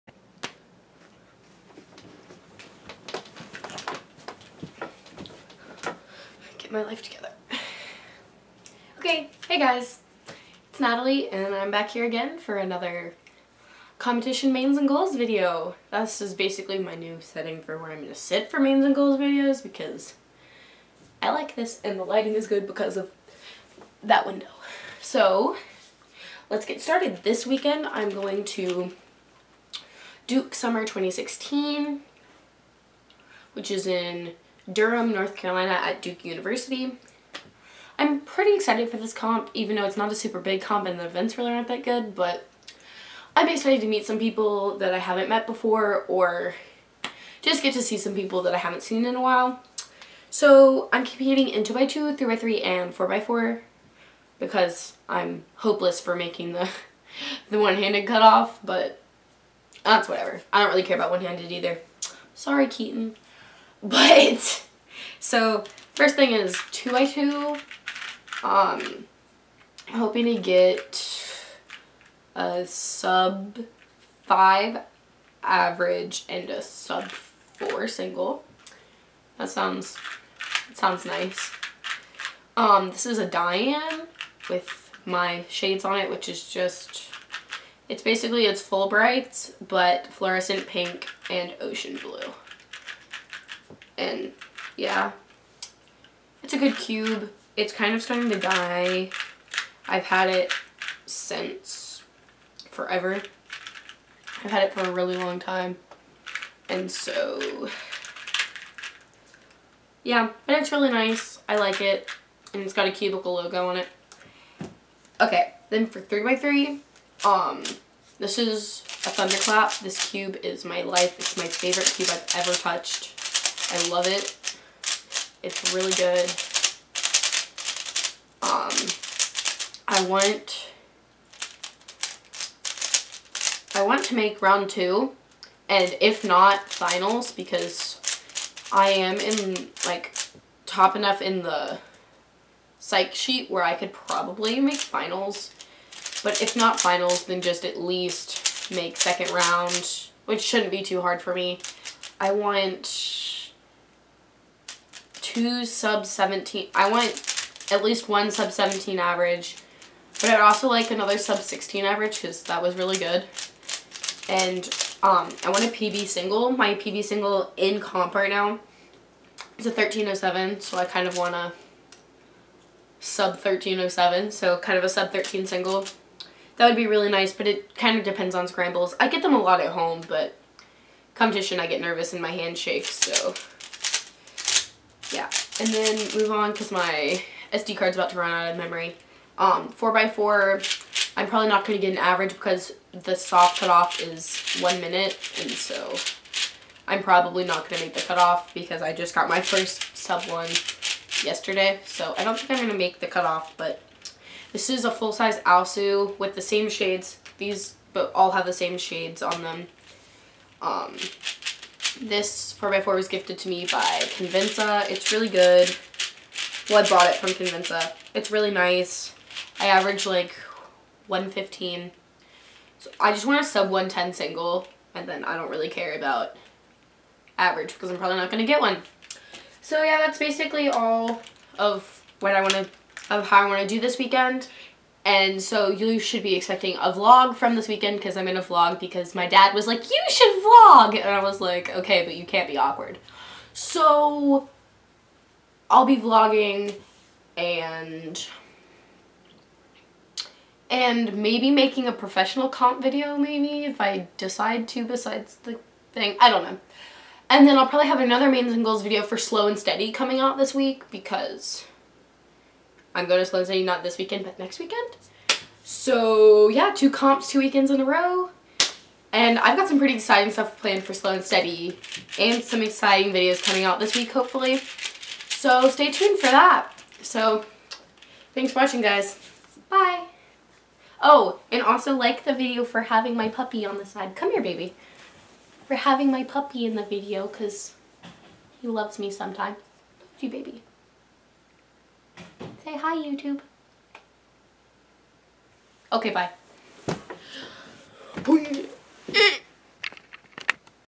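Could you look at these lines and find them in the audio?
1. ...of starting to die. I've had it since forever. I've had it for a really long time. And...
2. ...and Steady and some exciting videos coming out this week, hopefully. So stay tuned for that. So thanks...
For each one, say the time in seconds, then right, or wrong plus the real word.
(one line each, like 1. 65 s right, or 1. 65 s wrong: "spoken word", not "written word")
1. 97 s right
2. 271 s right.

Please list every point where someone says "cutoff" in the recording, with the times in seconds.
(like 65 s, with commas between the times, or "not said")
58 s, 193 s, 198 s, 203 s.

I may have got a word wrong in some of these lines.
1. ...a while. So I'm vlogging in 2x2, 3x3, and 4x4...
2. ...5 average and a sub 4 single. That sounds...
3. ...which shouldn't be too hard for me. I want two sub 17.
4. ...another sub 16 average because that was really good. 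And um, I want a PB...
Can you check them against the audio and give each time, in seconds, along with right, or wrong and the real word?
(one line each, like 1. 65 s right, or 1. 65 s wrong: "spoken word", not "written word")
1. 49 s wrong: "competing", not "vlogging"
2. 74 s right
3. 150 s right
4. 160 s right.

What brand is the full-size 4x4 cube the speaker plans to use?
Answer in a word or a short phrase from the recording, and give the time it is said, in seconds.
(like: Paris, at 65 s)
AoSu, at 205 s.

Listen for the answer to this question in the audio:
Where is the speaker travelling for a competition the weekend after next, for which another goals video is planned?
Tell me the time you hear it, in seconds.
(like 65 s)
263 s.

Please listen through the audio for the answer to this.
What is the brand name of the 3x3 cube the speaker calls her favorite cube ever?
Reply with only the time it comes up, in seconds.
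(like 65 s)
119 s.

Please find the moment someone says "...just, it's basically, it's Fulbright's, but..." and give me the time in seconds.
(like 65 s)
86 s.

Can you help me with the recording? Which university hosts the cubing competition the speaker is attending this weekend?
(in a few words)
Duke University.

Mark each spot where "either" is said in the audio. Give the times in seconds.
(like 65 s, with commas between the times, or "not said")
61 s.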